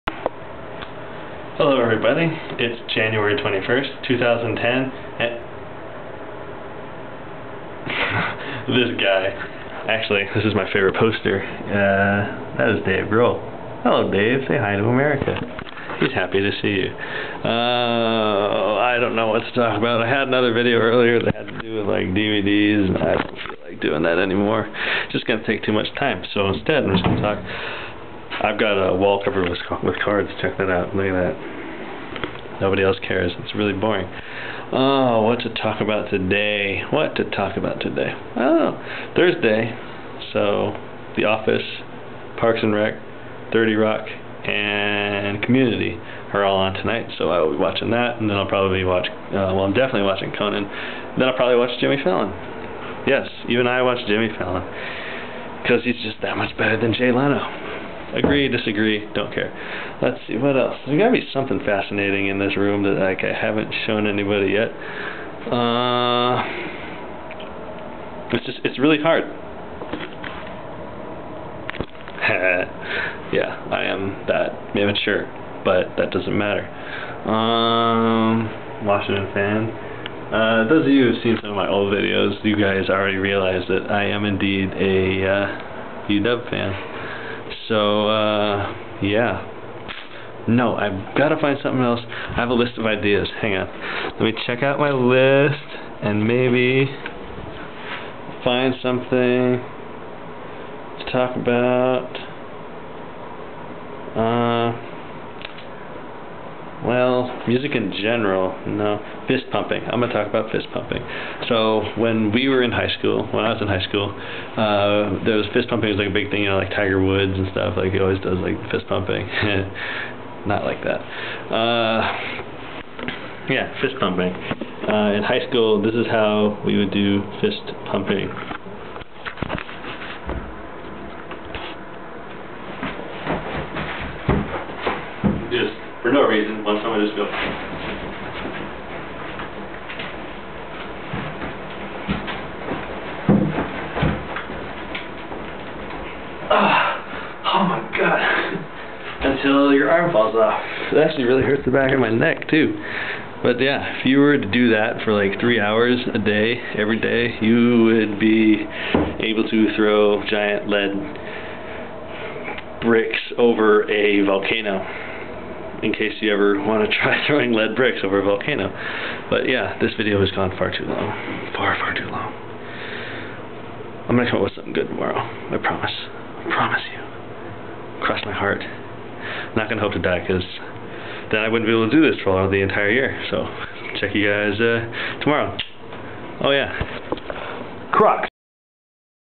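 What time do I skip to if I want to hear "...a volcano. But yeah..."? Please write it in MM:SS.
02:48.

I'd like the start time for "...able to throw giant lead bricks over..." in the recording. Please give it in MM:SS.
02:39.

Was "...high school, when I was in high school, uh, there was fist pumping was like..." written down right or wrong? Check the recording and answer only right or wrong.
right.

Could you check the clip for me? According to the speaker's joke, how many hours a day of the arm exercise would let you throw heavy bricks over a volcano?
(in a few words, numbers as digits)
3.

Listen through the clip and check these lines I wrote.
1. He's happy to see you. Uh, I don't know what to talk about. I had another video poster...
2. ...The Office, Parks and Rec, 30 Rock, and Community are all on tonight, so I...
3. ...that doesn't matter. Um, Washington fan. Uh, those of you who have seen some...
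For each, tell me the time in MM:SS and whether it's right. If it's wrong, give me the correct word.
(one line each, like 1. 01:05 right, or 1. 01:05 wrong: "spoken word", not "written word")
1. 00:15 wrong: "earlier", not "poster"
2. 00:41 right
3. 01:15 right.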